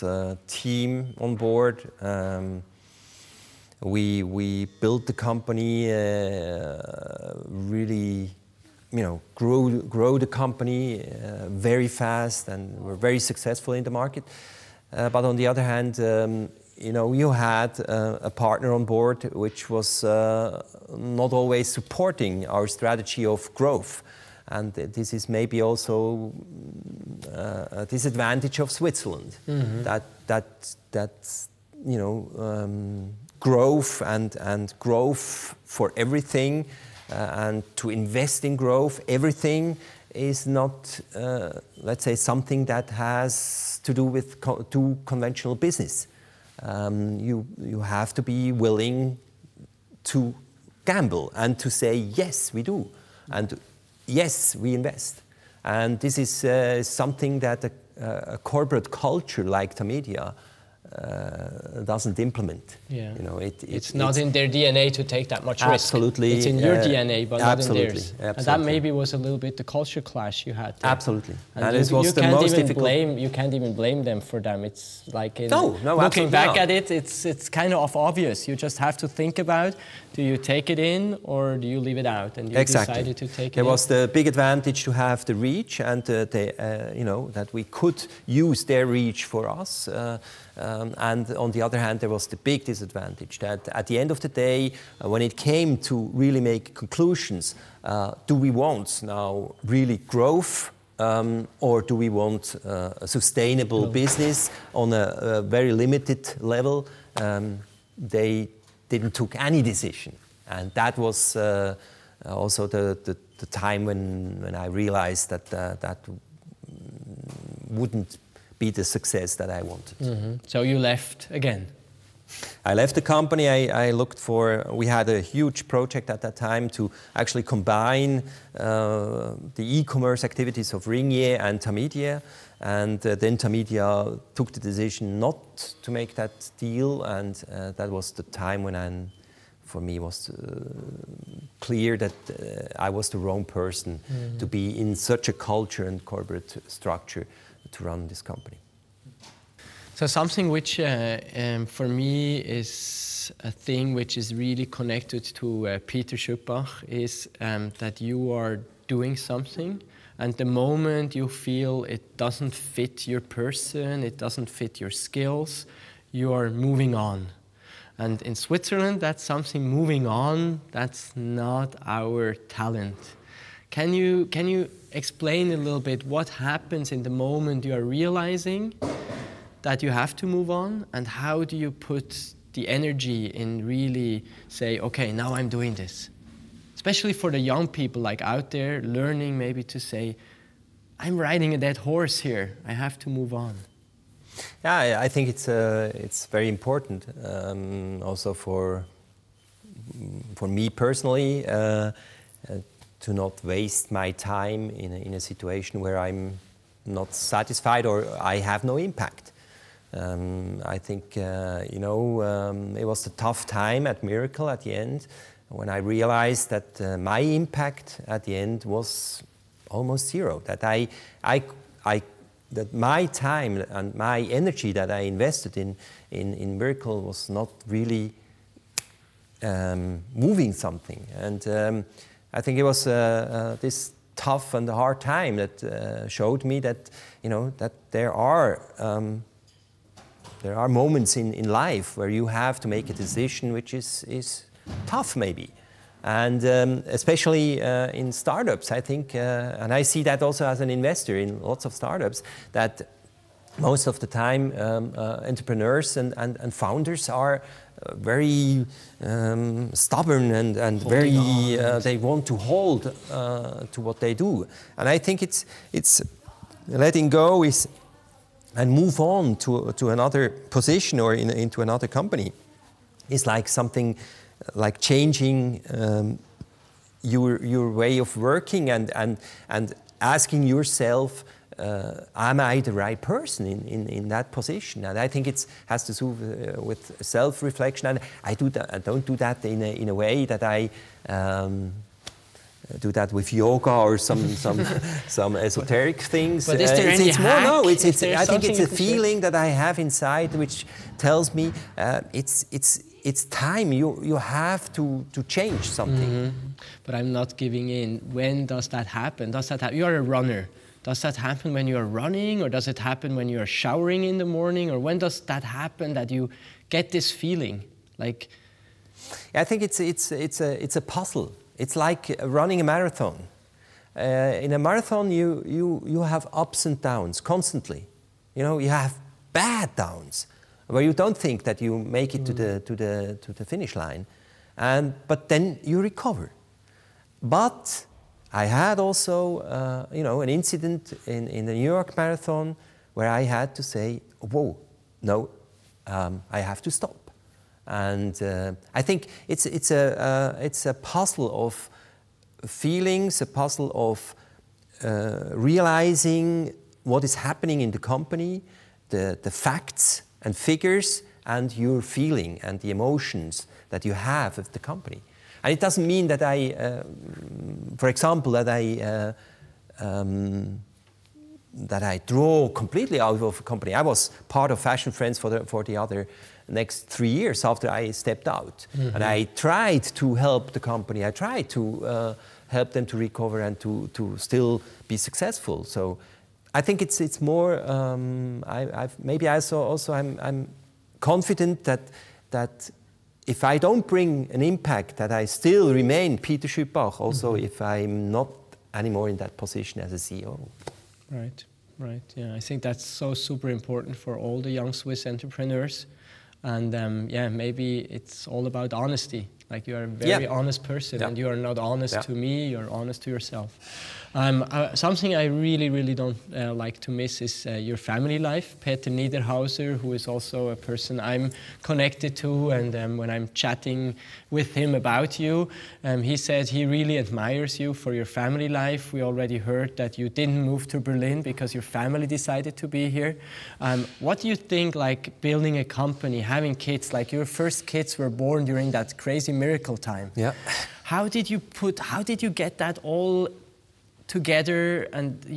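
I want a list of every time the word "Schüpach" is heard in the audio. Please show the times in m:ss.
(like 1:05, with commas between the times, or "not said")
2:36, 6:36.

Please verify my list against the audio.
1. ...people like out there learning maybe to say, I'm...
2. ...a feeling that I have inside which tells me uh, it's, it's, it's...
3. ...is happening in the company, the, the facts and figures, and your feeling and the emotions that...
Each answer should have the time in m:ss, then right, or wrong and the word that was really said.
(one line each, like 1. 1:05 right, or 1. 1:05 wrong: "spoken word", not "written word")
1. 3:07 right
2. 4:58 right
3. 5:57 right.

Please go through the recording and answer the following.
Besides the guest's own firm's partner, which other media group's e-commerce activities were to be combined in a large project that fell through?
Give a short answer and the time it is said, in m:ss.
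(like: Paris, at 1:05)
Ringier, at 2:10.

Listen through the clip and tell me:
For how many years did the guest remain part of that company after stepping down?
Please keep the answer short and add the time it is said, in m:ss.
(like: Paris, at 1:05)
3, at 6:16.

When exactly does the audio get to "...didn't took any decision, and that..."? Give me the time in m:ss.
1:48.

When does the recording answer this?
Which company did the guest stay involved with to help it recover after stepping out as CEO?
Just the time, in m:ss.
6:14.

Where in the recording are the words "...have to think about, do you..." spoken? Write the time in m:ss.
1:18.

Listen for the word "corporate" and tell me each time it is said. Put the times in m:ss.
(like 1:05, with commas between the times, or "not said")
0:58, 2:26.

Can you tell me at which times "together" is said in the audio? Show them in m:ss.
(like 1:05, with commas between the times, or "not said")
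7:24.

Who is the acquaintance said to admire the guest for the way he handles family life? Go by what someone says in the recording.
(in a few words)
Peter Niederhauser.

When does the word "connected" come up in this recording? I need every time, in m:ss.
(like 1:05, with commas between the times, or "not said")
2:34, 7:01.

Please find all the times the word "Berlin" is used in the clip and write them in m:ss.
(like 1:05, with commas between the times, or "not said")
7:10.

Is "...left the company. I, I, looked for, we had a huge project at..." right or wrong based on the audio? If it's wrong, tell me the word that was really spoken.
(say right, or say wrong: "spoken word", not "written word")
right.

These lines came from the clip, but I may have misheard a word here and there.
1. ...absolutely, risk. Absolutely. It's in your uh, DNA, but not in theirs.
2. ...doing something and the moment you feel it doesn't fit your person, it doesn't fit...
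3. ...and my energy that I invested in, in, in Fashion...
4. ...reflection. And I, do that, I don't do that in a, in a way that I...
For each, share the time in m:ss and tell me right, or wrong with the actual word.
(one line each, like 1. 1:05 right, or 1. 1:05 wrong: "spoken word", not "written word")
1. 1:05 right
2. 2:38 right
3. 3:43 wrong: "Miracle", not "Fashion"
4. 4:47 right.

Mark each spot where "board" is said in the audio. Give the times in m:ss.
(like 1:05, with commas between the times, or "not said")
0:01, 0:18.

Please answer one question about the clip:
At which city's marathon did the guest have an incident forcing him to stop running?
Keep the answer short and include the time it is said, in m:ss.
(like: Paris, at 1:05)
New York, at 5:41.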